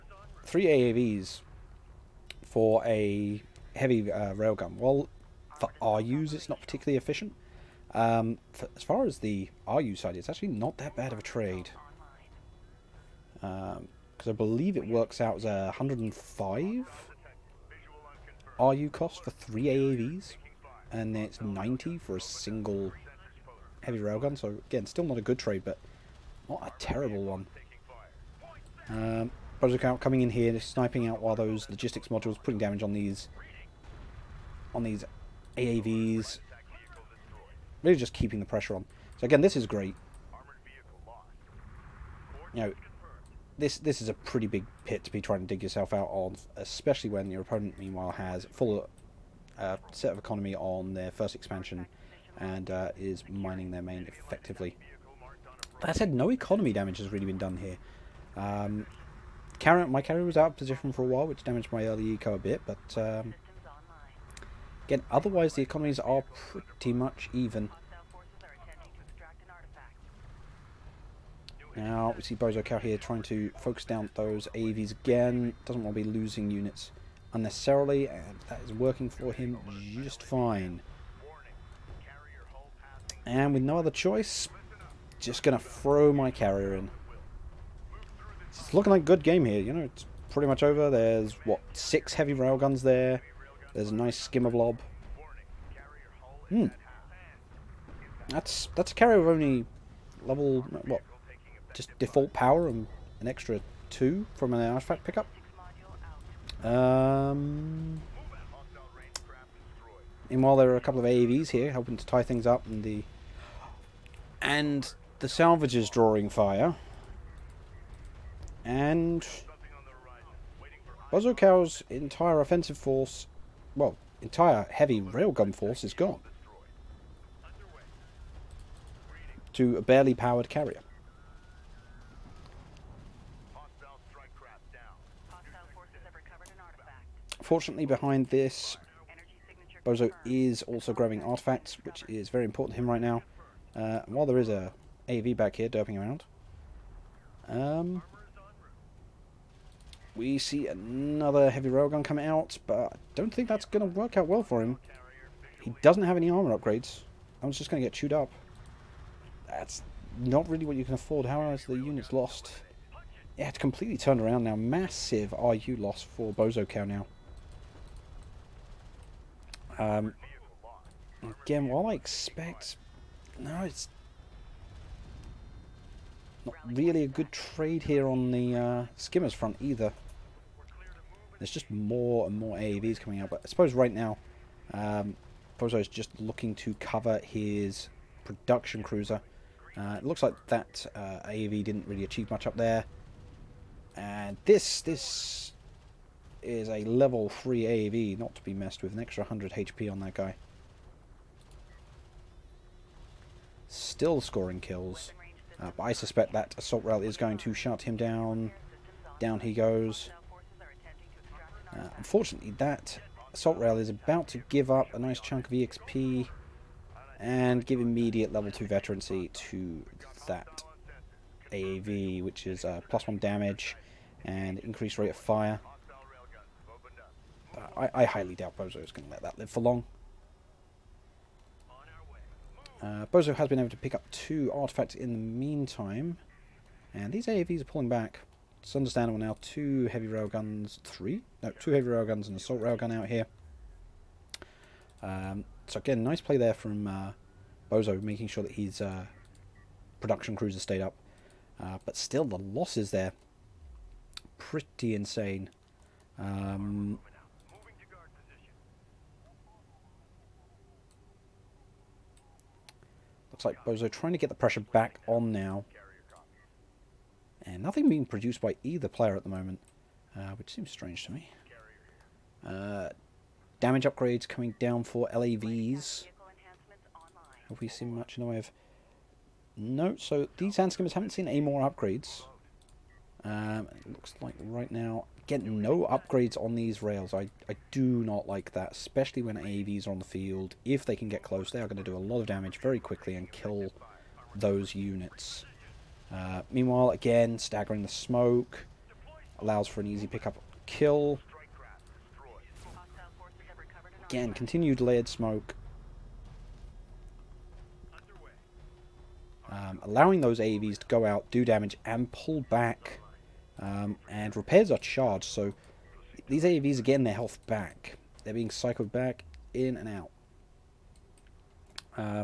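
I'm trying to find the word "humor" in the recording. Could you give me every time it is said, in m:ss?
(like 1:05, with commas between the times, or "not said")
not said.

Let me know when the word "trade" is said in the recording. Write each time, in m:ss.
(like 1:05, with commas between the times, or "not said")
0:11, 0:25, 2:57.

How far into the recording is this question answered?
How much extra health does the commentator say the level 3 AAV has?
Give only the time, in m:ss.
3:19.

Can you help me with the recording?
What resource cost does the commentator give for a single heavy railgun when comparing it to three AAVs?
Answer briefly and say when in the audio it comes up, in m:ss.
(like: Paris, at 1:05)
90, at 0:21.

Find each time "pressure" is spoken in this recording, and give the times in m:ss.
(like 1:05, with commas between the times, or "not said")
0:38, 4:24.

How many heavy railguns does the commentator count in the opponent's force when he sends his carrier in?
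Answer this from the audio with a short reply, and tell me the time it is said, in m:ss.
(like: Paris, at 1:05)
6, at 1:31.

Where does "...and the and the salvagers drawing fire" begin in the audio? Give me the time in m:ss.
1:52.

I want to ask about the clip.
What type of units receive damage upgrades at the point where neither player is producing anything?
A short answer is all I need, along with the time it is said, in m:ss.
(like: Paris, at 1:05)
LAVs, at 4:35.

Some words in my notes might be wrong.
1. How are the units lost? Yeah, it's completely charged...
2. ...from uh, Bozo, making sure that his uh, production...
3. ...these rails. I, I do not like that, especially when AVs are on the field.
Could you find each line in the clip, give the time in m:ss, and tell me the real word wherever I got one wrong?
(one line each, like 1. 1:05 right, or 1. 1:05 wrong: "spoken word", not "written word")
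1. 2:41 wrong: "turned", not "charged"
2. 4:06 right
3. 4:46 right.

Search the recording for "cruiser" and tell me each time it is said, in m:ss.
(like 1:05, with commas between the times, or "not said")
3:08.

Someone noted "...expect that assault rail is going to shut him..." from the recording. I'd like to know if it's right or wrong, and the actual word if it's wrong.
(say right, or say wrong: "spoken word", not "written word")
wrong: "suspect", not "expect".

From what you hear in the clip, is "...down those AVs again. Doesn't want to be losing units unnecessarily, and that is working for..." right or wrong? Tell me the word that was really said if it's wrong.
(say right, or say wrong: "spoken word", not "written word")
right.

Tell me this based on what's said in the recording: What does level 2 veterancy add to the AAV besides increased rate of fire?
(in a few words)
+1 damage.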